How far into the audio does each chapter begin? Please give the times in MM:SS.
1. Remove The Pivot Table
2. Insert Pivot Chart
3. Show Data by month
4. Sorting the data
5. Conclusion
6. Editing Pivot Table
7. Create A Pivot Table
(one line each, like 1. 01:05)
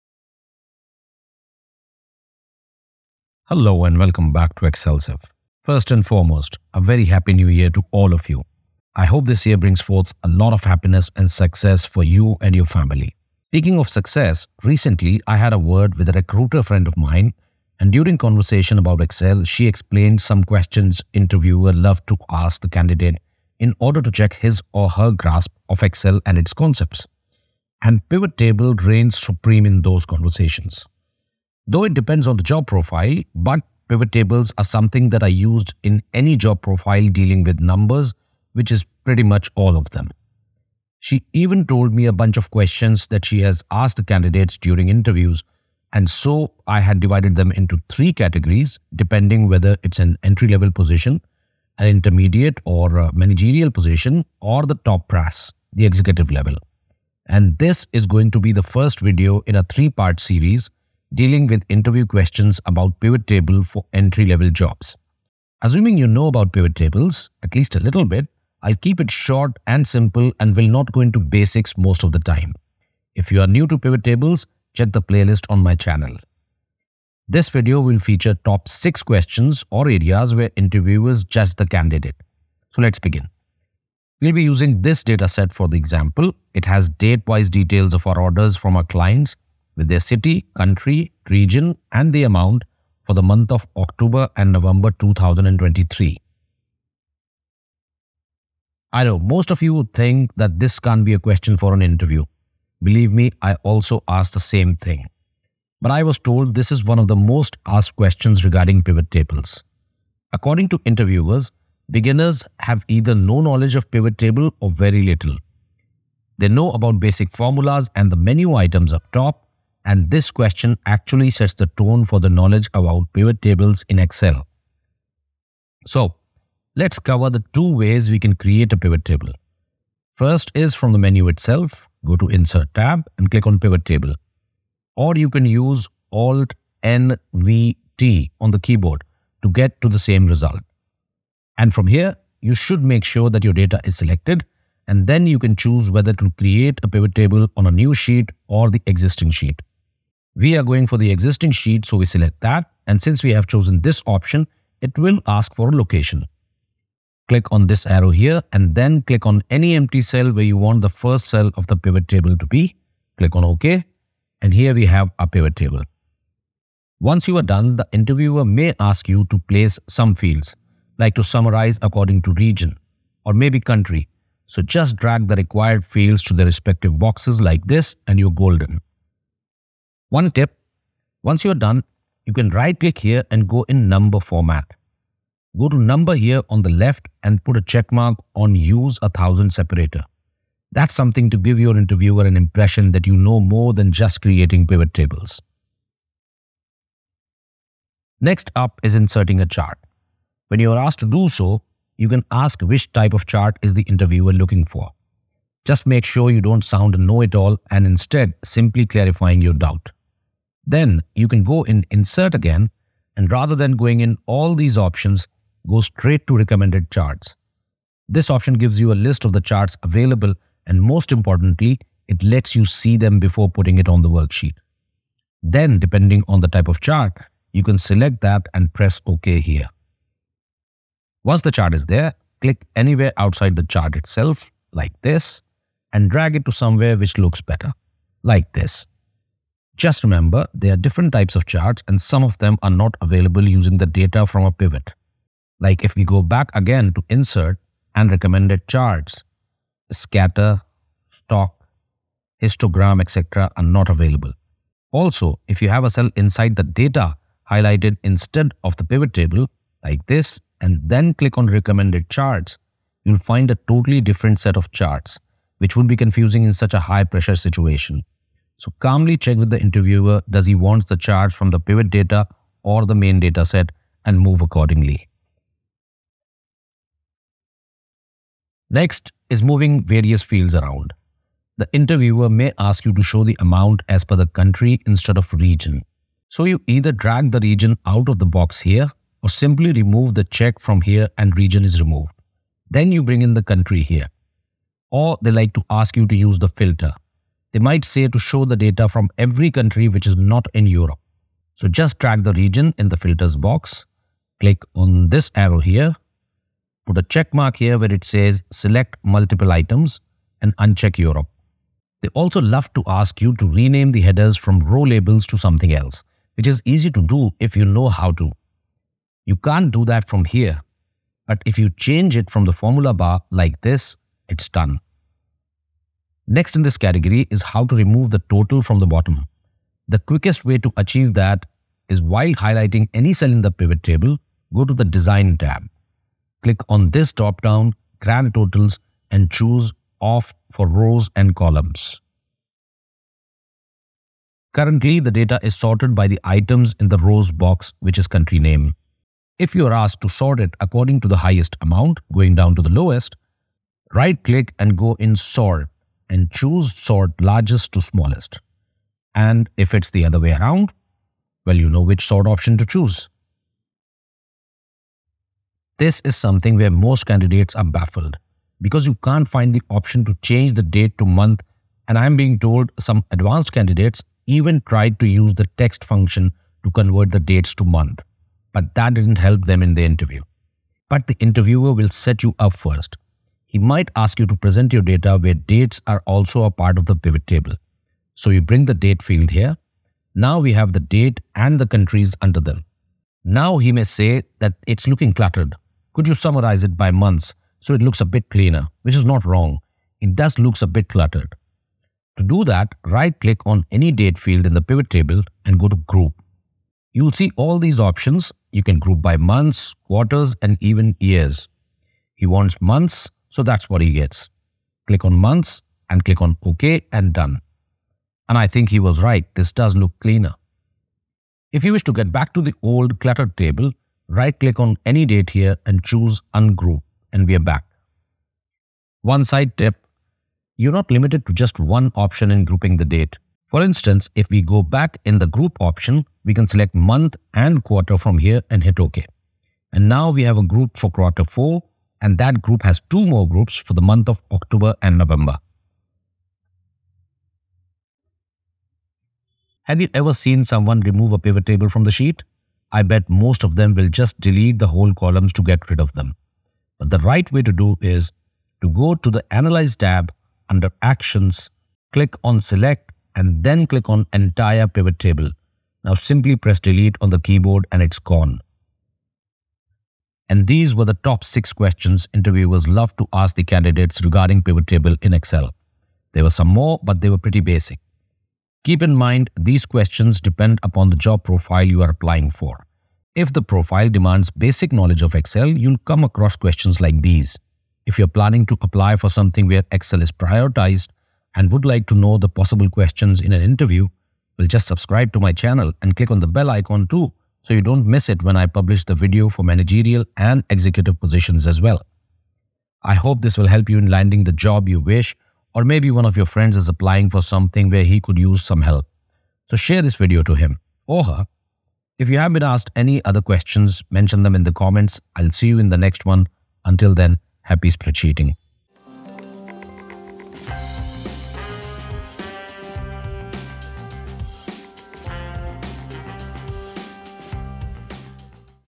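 1. 07:27
2. 03:16
3. 06:04
4. 05:43
5. 07:50
6. 04:36
7. 01:37.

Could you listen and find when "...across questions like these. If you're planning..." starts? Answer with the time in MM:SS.
08:06.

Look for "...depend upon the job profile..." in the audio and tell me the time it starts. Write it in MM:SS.
08:00.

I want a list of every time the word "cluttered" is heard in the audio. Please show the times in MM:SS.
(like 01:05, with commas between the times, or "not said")
06:35, 06:40, 07:02.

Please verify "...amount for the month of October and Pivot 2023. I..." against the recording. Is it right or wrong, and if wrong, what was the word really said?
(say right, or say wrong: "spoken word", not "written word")
wrong: "November", not "Pivot".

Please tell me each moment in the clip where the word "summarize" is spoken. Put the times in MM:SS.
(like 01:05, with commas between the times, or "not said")
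02:51, 06:36.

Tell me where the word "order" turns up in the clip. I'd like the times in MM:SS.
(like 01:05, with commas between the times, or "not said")
00:23, 01:28.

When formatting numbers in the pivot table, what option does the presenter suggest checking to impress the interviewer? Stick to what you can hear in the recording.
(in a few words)
Use a thousand separator.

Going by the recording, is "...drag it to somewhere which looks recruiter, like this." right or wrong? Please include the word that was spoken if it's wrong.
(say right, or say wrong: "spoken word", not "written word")
wrong: "better", not "recruiter".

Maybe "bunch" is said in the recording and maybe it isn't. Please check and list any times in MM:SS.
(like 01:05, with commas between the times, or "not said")
00:42.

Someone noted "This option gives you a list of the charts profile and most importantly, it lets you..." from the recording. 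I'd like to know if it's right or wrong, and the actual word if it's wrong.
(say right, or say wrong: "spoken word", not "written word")
wrong: "available", not "profile".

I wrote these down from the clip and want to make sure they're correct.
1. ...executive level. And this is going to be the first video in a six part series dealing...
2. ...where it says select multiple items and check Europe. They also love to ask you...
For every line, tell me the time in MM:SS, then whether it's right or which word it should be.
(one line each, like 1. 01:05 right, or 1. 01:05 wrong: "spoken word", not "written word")
1. 00:55 wrong: "three", not "six"
2. 05:07 wrong: "uncheck", not "check".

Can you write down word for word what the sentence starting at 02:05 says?
So, let's cover the two ways we can create a pivot table.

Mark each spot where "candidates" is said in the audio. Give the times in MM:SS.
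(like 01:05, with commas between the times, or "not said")
00:22, 00:44, 01:21, 06:07, 06:13, 07:53.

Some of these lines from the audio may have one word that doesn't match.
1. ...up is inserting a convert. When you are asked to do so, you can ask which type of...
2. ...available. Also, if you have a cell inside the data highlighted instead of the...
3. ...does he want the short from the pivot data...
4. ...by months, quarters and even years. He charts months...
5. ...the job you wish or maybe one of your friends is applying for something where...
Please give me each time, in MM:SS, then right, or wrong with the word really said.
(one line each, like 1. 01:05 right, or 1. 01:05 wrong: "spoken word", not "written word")
1. 03:18 wrong: "chart", not "convert"
2. 04:13 right
3. 04:30 wrong: "chart", not "short"
4. 06:49 wrong: "wants", not "charts"
5. 08:24 right.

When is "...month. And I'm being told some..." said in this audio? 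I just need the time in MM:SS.
06:11.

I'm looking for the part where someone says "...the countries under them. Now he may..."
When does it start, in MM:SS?
06:31.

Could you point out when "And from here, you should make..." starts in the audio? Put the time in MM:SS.
02:21.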